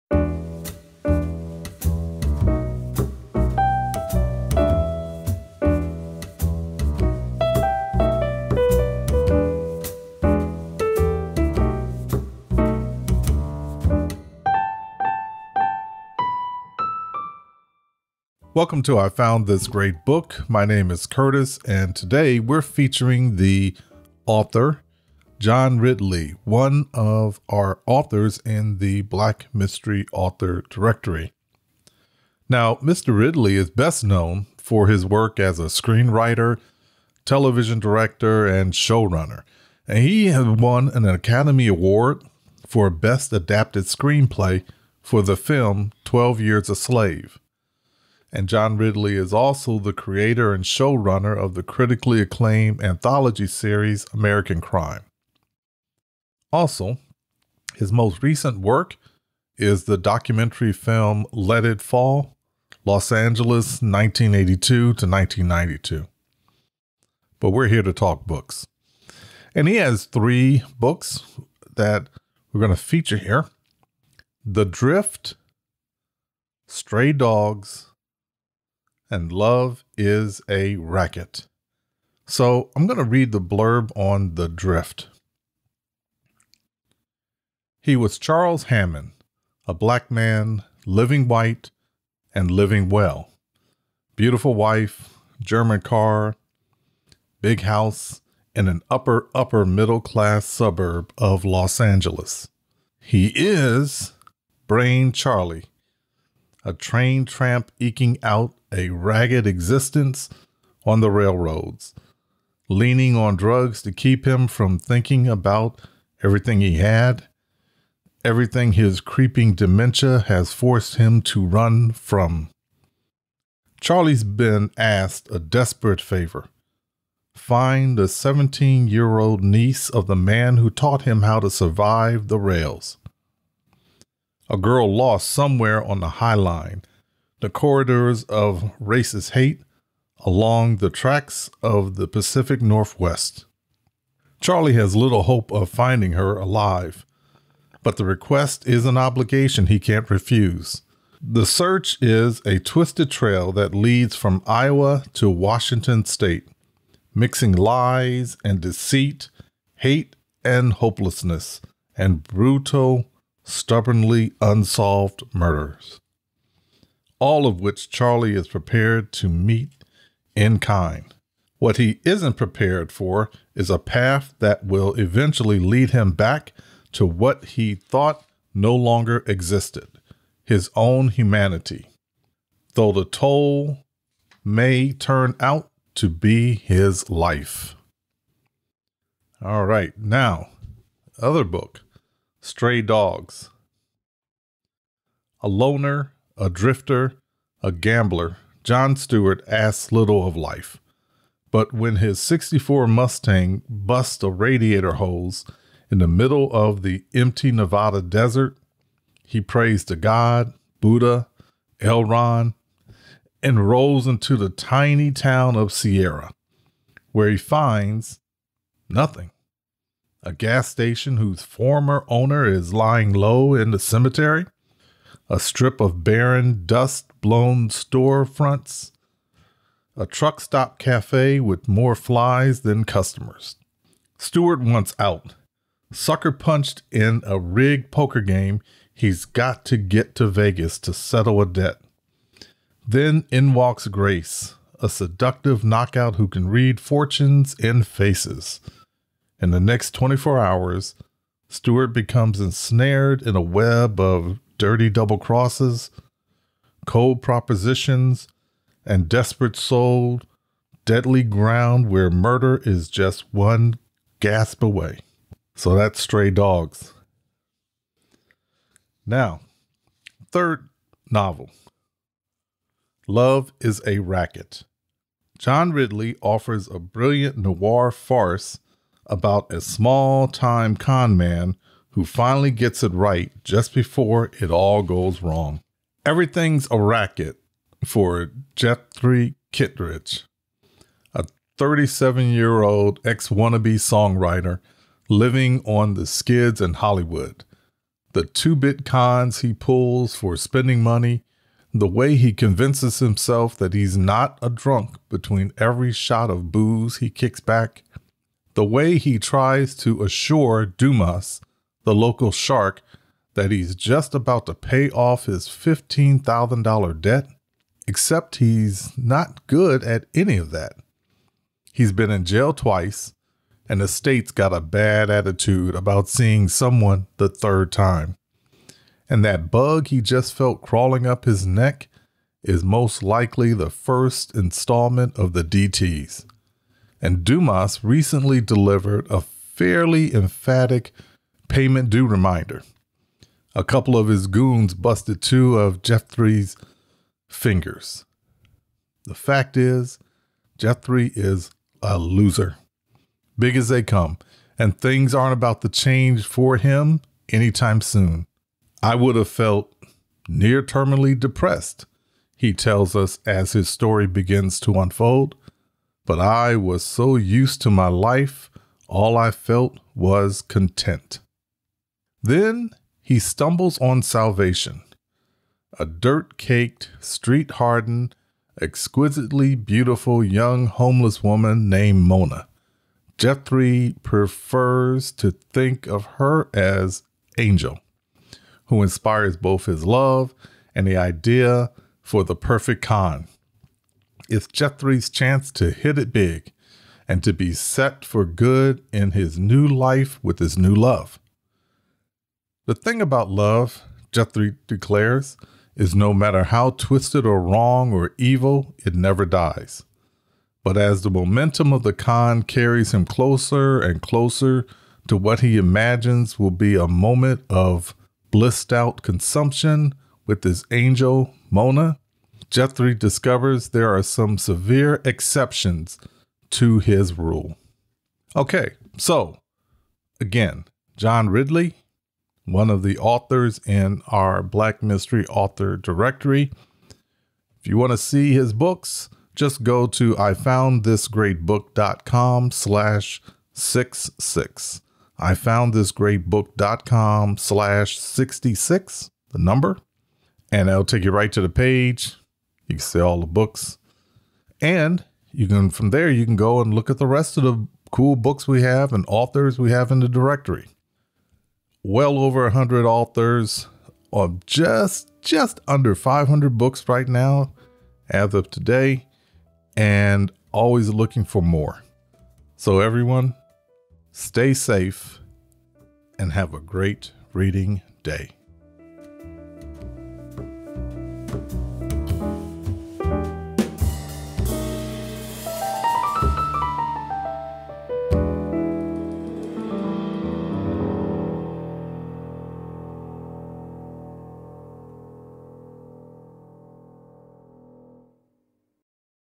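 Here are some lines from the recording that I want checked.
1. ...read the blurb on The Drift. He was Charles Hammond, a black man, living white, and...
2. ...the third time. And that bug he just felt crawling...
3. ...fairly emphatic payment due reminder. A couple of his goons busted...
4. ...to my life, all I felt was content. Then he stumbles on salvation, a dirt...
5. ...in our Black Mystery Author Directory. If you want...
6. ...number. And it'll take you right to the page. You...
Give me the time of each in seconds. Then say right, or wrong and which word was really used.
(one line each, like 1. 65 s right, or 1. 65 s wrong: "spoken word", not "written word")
1. 83 s right
2. 327 s right
3. 339 s right
4. 367 s right
5. 433 s right
6. 449 s right.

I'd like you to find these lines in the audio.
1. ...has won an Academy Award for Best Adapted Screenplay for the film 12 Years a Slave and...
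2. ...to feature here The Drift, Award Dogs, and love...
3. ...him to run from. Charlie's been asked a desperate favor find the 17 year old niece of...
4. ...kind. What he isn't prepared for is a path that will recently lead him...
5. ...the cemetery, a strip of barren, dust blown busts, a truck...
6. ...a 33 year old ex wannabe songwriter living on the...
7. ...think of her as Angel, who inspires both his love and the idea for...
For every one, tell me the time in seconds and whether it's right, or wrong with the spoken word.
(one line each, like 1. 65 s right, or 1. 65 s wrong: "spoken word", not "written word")
1. 40 s right
2. 72 s wrong: "Stray", not "Award"
3. 120 s right
4. 170 s wrong: "eventually", not "recently"
5. 223 s wrong: "storefronts", not "busts"
6. 291 s wrong: "37", not "33"
7. 385 s right.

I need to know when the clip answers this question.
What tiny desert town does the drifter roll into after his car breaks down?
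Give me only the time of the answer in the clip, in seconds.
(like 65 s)
215 s.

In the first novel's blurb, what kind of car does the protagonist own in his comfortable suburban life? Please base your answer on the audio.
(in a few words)
German car.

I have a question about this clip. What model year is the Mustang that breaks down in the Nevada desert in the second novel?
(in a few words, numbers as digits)
64.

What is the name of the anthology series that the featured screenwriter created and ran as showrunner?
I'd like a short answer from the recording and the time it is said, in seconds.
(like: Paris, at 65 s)
American Crime, at 54 s.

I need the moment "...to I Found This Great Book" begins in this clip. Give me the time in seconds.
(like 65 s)
18 s.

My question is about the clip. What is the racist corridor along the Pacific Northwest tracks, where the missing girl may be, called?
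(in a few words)
High Line.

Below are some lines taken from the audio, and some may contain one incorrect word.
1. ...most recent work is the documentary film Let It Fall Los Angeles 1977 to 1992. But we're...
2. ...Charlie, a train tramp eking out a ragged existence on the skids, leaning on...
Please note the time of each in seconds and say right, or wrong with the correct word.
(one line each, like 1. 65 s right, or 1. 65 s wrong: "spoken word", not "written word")
1. 57 s wrong: "1982", not "1977"
2. 105 s wrong: "railroads", not "skids".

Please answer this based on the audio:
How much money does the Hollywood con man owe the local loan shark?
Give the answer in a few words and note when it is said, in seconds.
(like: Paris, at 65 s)
$15,000, at 315 s.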